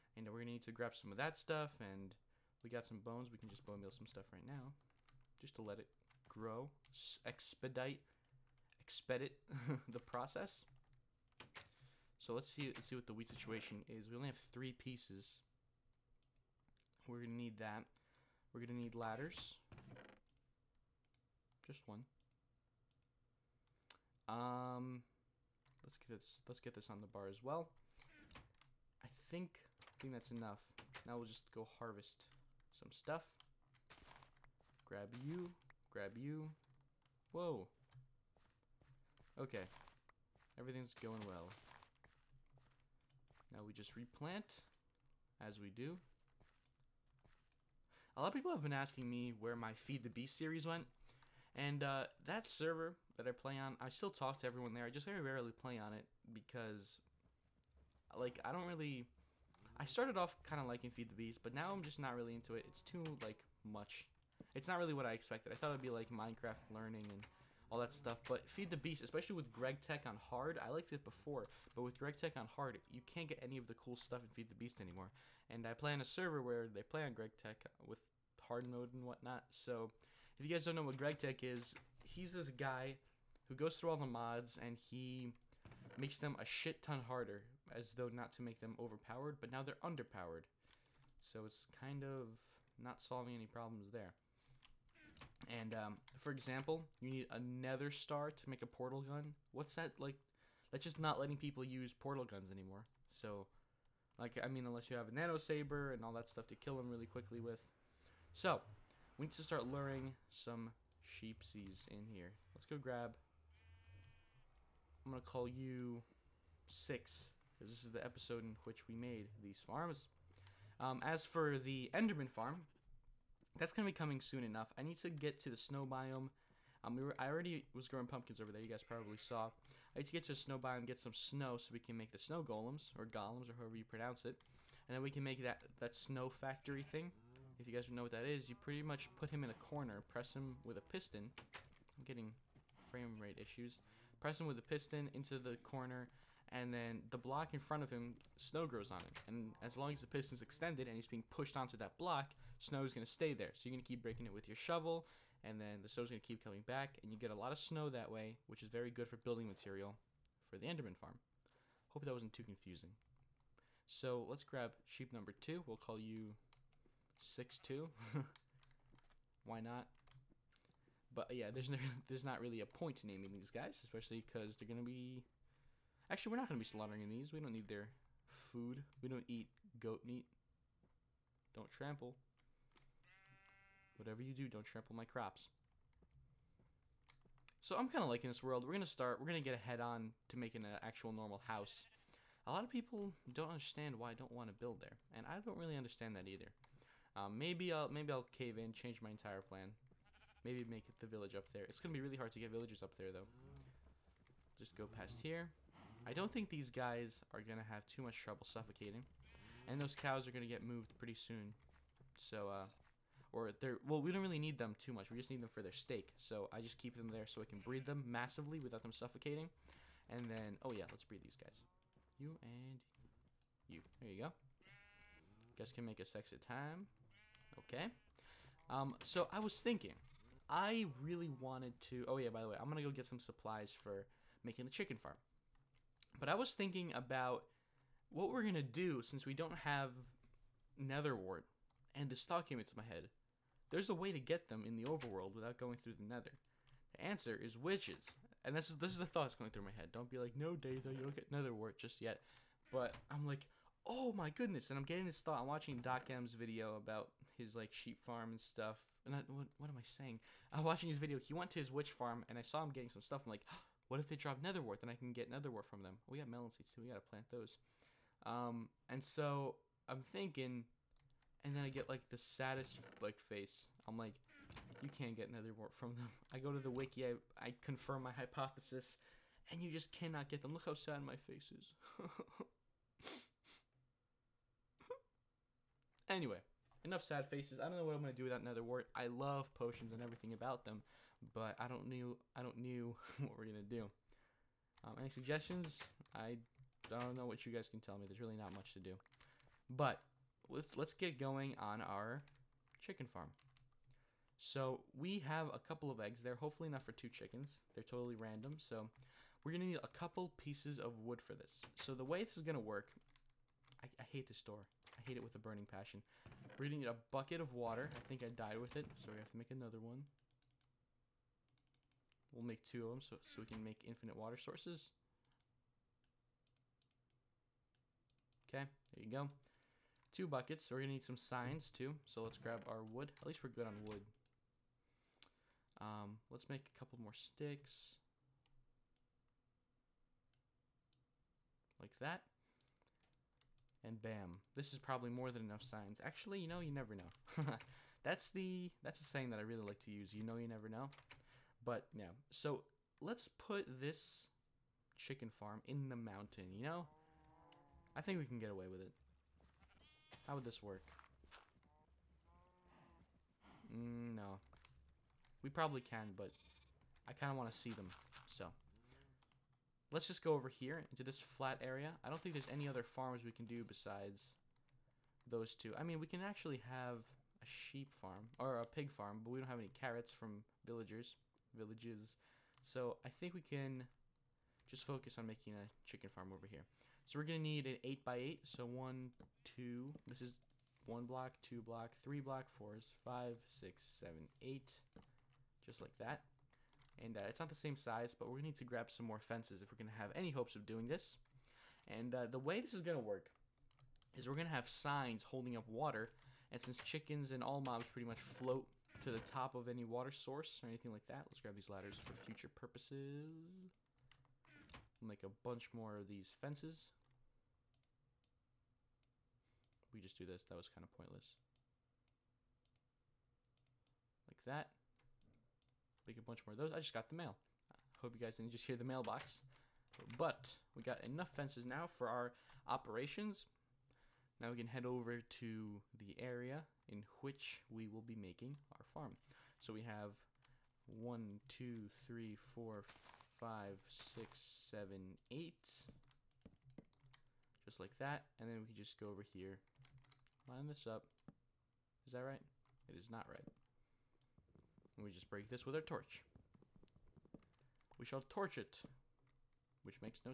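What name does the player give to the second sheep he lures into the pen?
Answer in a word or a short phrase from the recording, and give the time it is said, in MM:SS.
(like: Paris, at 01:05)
Six two, at 02:47.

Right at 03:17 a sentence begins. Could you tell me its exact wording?
Um, maybe I'll maybe I'll cave in, change my entire plan.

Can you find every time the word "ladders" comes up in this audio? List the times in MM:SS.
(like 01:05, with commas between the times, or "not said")
00:18, 06:51.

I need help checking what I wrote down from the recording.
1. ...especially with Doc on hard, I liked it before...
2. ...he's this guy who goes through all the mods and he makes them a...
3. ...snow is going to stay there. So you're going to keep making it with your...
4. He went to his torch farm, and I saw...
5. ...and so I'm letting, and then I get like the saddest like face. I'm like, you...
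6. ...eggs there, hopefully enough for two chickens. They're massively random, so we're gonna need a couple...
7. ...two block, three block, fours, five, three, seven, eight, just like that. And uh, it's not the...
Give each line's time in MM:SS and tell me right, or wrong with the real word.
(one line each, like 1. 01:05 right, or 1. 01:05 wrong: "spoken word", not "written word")
1. 01:09 wrong: "GregTech", not "Doc"
2. 01:22 right
3. 02:32 wrong: "breaking", not "making"
4. 04:21 wrong: "witch", not "torch"
5. 04:28 wrong: "thinking", not "letting"
6. 05:05 wrong: "totally", not "massively"
7. 06:31 wrong: "six", not "three".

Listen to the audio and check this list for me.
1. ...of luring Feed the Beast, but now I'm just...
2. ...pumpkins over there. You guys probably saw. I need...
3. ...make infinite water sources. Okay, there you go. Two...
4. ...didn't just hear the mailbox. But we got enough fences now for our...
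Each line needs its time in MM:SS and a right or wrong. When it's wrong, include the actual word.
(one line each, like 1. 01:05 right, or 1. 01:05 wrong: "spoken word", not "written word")
1. 01:00 wrong: "liking", not "luring"
2. 02:08 right
3. 05:23 right
4. 07:08 right.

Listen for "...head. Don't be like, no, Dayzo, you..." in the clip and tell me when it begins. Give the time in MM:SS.
04:09.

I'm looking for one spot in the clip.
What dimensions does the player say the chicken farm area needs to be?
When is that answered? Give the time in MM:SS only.
06:27.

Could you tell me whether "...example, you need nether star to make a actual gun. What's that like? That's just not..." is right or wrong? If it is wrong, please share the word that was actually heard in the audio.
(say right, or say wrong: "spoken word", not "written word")
wrong: "portal", not "actual".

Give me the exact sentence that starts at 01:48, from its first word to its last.
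So, we need to start luring some sheepsies in here.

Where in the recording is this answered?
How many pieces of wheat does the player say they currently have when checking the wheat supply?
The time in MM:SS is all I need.
00:14.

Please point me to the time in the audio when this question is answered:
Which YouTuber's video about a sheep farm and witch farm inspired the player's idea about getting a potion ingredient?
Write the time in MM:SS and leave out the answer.
04:15.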